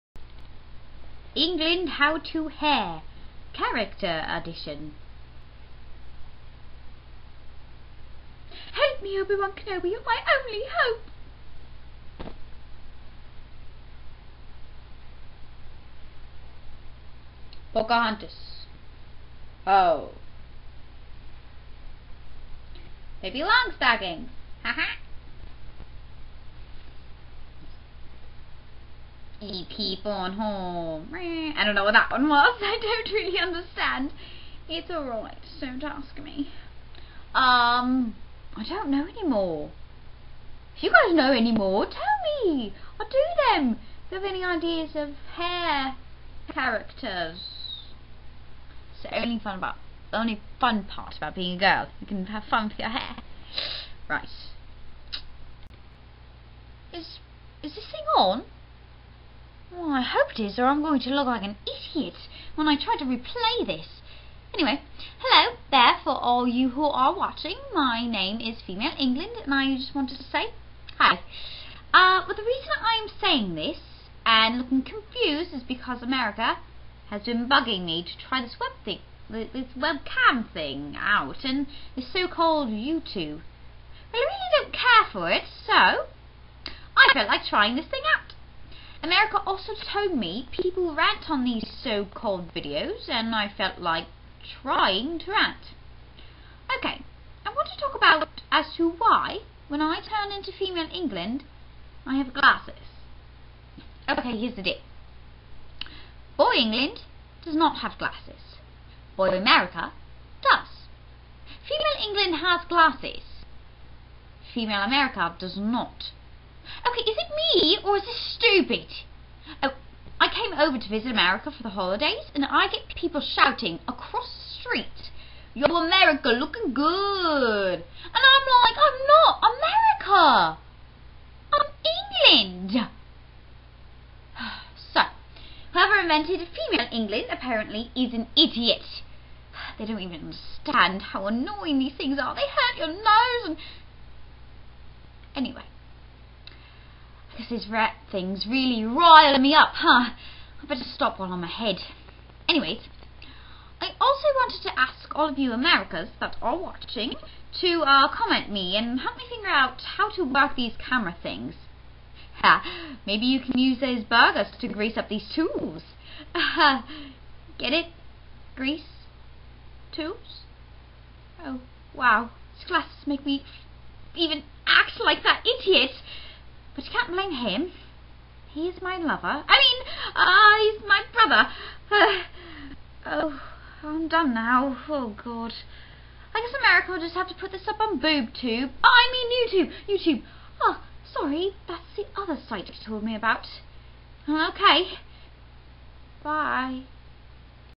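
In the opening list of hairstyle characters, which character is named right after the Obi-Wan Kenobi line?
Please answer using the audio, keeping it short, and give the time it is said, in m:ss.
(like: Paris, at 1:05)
Pocahontas, at 0:17.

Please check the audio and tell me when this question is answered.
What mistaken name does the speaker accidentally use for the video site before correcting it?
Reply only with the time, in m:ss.
3:07.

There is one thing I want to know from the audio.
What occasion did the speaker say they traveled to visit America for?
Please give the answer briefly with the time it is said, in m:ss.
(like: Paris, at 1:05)
The holidays, at 2:01.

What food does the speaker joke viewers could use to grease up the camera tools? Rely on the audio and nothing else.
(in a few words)
Burgers.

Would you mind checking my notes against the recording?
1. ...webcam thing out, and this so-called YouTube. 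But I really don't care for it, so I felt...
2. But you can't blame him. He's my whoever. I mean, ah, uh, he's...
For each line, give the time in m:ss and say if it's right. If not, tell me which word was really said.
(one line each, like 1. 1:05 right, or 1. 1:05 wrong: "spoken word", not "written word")
1. 1:19 right
2. 2:56 wrong: "lover", not "whoever".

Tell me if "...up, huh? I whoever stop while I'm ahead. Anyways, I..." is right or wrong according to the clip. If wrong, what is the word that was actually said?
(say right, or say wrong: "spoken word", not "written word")
wrong: "better", not "whoever".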